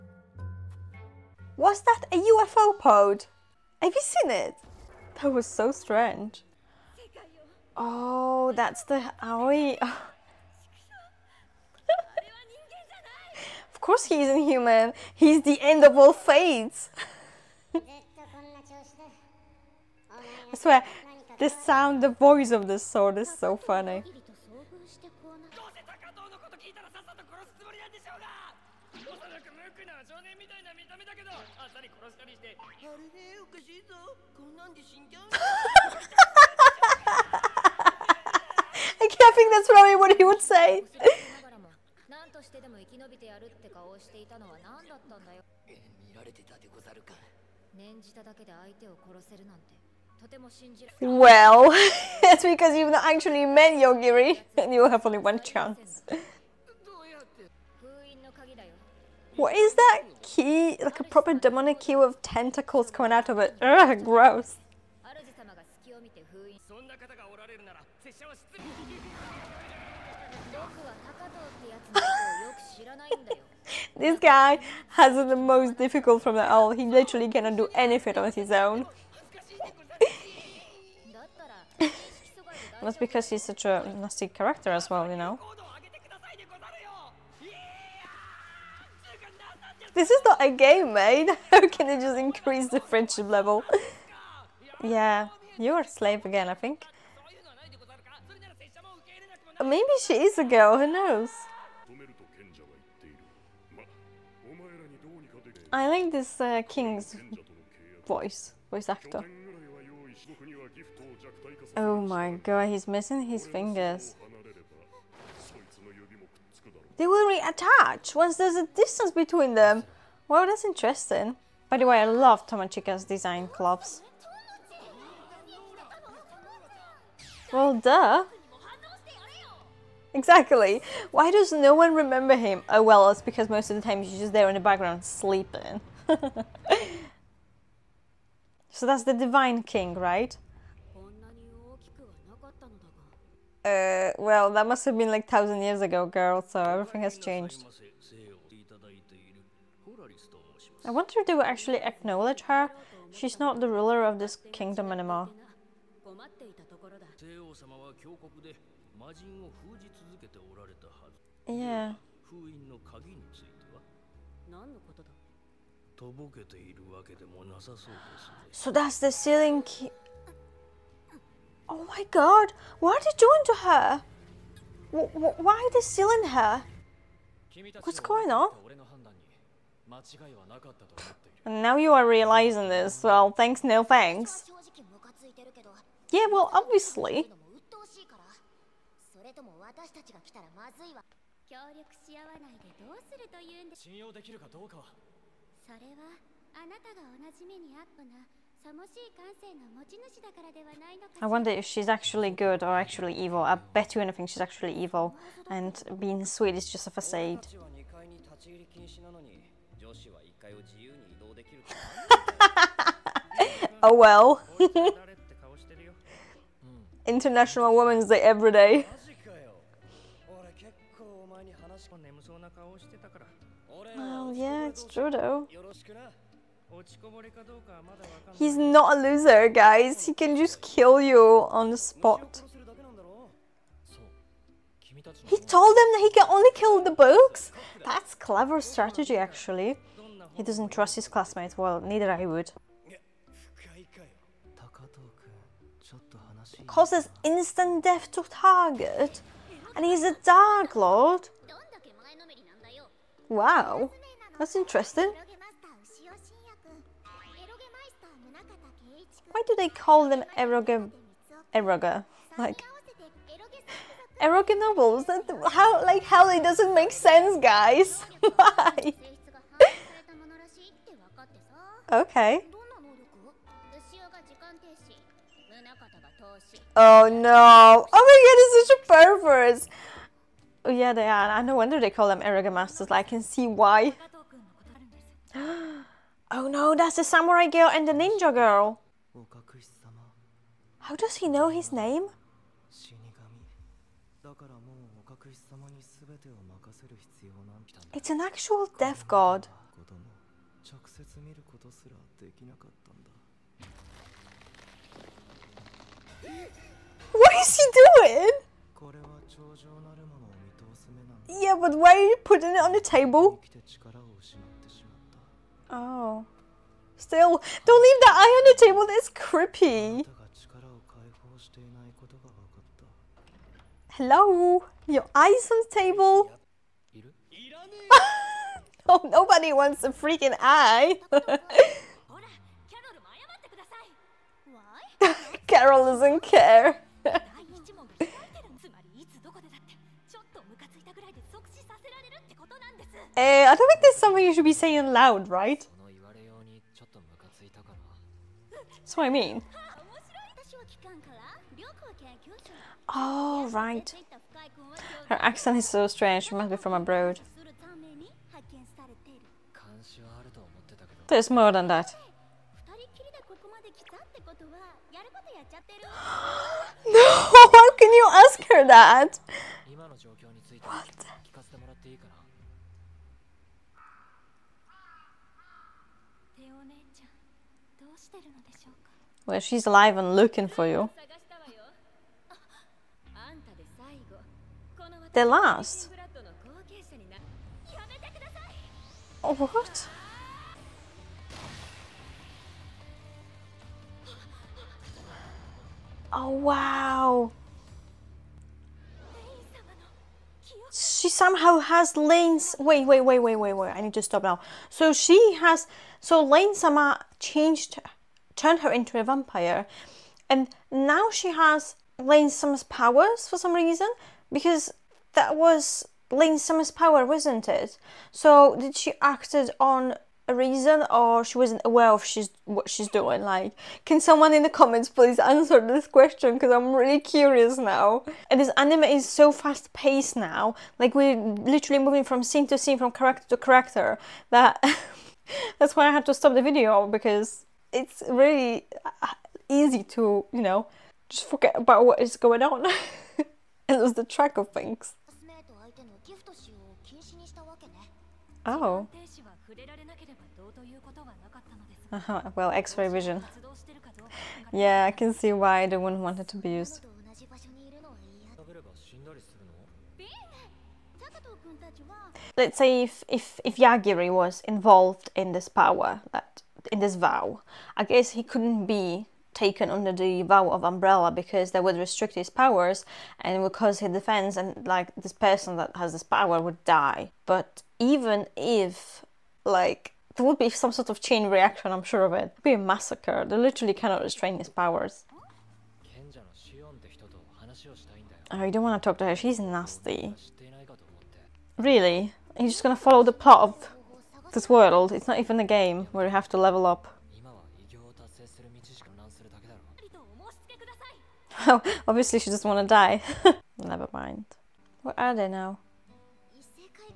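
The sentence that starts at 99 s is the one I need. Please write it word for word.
Maybe she is a girl, who knows?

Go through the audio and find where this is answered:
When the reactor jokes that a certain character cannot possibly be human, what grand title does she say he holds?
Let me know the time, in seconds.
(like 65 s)
15 s.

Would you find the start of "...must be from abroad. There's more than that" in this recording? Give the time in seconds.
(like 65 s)
356 s.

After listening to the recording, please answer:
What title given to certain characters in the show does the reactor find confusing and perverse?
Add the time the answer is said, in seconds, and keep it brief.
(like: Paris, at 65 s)
Eroge Masters, at 282 s.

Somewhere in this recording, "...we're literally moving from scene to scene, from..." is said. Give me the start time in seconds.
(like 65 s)
430 s.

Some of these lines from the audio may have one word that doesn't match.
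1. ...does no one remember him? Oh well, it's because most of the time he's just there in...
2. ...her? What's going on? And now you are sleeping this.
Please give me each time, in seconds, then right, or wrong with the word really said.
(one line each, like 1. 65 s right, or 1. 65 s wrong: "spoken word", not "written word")
1. 131 s right
2. 176 s wrong: "realizing", not "sleeping".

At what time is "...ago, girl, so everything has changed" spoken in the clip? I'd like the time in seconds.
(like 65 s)
145 s.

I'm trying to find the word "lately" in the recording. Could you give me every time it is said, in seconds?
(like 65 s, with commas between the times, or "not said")
not said.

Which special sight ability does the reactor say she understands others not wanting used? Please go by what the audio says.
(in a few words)
X-ray vision.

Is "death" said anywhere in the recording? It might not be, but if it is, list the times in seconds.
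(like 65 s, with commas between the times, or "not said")
247 s, 298 s.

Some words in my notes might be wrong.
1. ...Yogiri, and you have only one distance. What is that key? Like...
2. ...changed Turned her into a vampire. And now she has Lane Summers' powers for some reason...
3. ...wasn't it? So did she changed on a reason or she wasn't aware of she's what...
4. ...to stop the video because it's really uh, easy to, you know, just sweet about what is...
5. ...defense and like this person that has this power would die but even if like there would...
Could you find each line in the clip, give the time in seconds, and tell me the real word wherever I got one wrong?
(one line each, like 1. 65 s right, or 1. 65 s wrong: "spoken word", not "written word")
1. 53 s wrong: "chance", not "distance"
2. 407 s right
3. 417 s wrong: "acted", not "changed"
4. 436 s wrong: "forget", not "sweet"
5. 473 s right.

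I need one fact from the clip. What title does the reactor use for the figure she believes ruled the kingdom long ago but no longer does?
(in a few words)
Divine King.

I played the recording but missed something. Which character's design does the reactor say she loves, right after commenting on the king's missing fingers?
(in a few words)
Tomochika.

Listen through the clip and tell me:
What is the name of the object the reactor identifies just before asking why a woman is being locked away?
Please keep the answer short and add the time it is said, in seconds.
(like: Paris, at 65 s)
The sealing key, at 169 s.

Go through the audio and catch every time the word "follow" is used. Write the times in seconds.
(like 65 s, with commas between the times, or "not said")
492 s.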